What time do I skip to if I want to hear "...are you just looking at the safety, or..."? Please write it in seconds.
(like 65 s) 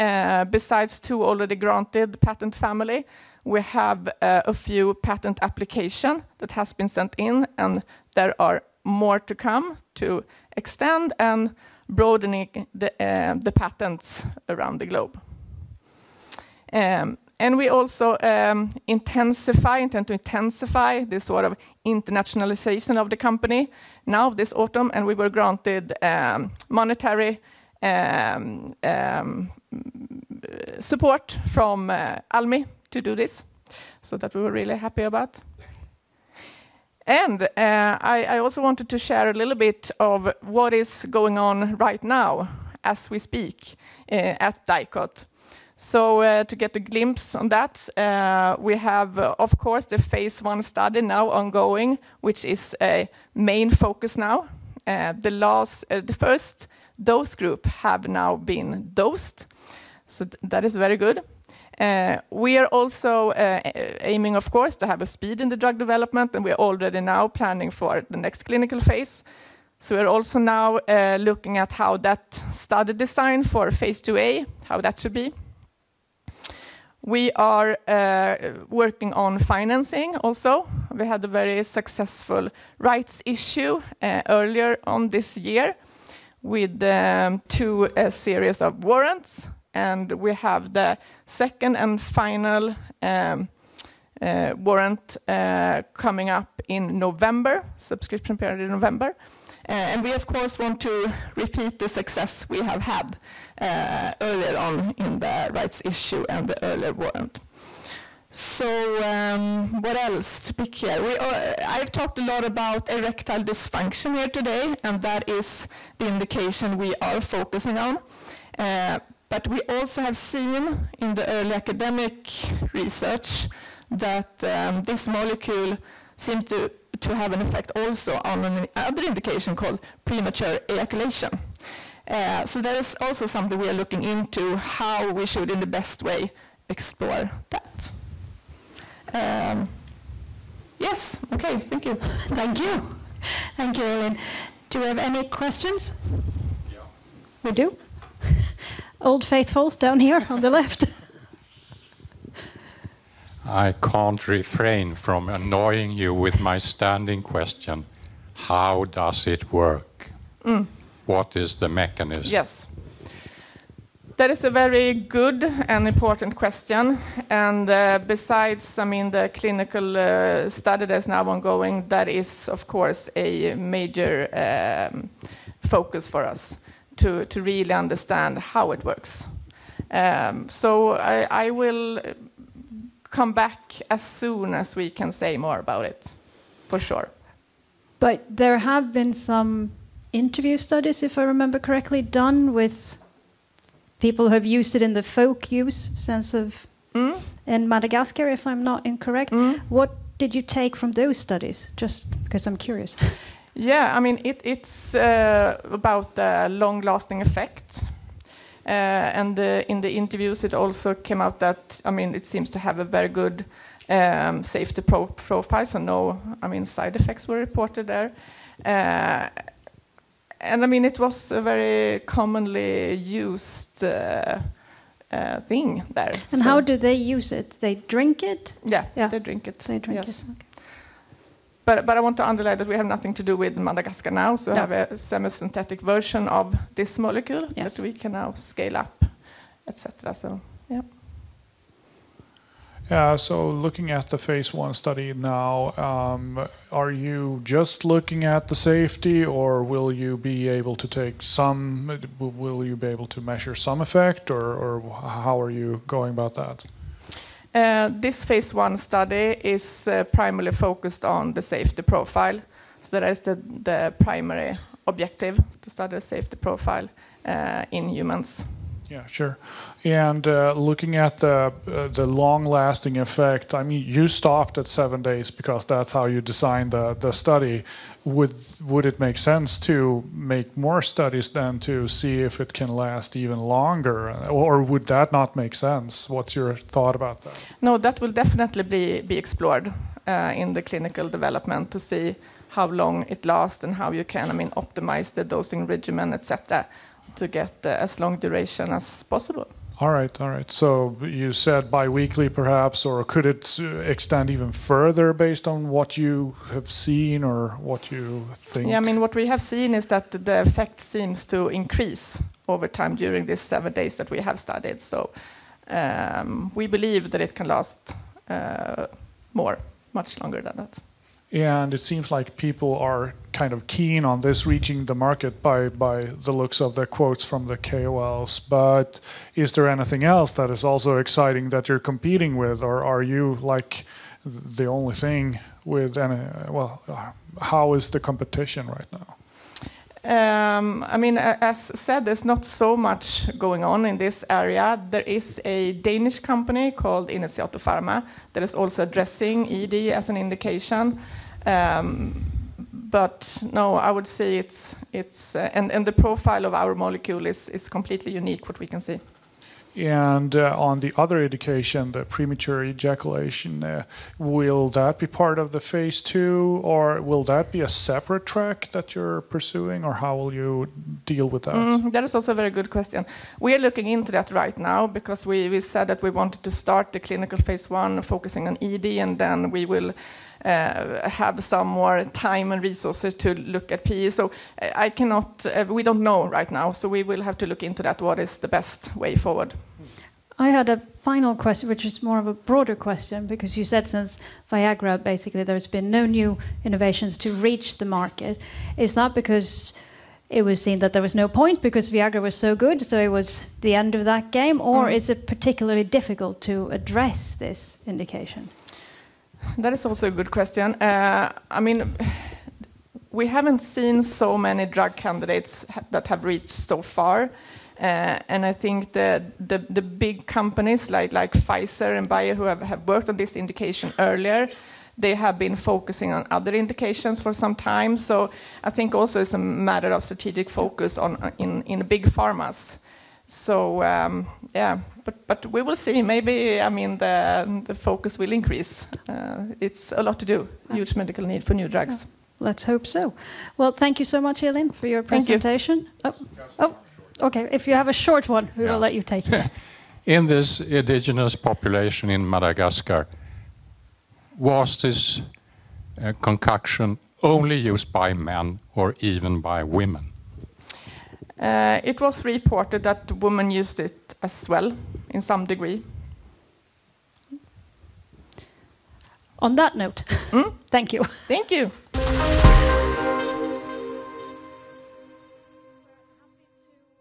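246 s.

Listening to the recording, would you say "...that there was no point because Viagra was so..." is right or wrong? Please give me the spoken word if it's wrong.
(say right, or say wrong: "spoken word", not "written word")
right.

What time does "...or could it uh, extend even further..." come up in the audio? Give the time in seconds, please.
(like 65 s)
302 s.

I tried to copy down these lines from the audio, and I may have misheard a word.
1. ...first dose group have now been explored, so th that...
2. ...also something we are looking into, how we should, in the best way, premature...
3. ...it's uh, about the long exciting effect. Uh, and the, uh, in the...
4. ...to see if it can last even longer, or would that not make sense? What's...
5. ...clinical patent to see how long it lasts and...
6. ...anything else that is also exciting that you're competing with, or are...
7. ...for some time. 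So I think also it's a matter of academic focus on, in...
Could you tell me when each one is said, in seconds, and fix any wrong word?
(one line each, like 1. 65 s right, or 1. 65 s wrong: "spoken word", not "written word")
1. 56 s wrong: "dosed", not "explored"
2. 132 s wrong: "explore", not "premature"
3. 204 s wrong: "lasting", not "exciting"
4. 281 s right
5. 290 s wrong: "development", not "patent"
6. 329 s right
7. 427 s wrong: "strategic", not "academic".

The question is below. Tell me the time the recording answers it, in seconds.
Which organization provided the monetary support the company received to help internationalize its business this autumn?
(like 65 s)
32 s.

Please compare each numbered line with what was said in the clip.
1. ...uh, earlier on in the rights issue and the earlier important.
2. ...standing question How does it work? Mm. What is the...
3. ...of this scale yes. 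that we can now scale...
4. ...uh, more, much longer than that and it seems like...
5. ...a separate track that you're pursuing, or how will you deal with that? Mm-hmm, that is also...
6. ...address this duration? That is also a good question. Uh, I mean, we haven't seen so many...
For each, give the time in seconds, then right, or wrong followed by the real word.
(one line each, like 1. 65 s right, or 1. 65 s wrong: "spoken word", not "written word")
1. 103 s wrong: "warrant", not "important"
2. 156 s right
3. 236 s wrong: "molecule", not "scale"
4. 318 s right
5. 367 s right
6. 406 s wrong: "indication", not "duration".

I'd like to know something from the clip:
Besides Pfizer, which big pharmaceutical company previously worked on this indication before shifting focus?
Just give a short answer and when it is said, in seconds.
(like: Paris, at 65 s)
Bayer, at 422 s.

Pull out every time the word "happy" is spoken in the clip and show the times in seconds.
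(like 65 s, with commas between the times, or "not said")
34 s.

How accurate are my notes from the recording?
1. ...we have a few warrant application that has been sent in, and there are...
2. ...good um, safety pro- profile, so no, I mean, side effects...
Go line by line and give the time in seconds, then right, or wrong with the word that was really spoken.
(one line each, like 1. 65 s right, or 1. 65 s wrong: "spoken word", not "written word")
1. 3 s wrong: "patent", not "warrant"
2. 213 s right.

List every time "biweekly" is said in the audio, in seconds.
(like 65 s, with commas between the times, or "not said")
301 s.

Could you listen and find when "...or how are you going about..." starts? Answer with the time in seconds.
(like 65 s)
254 s.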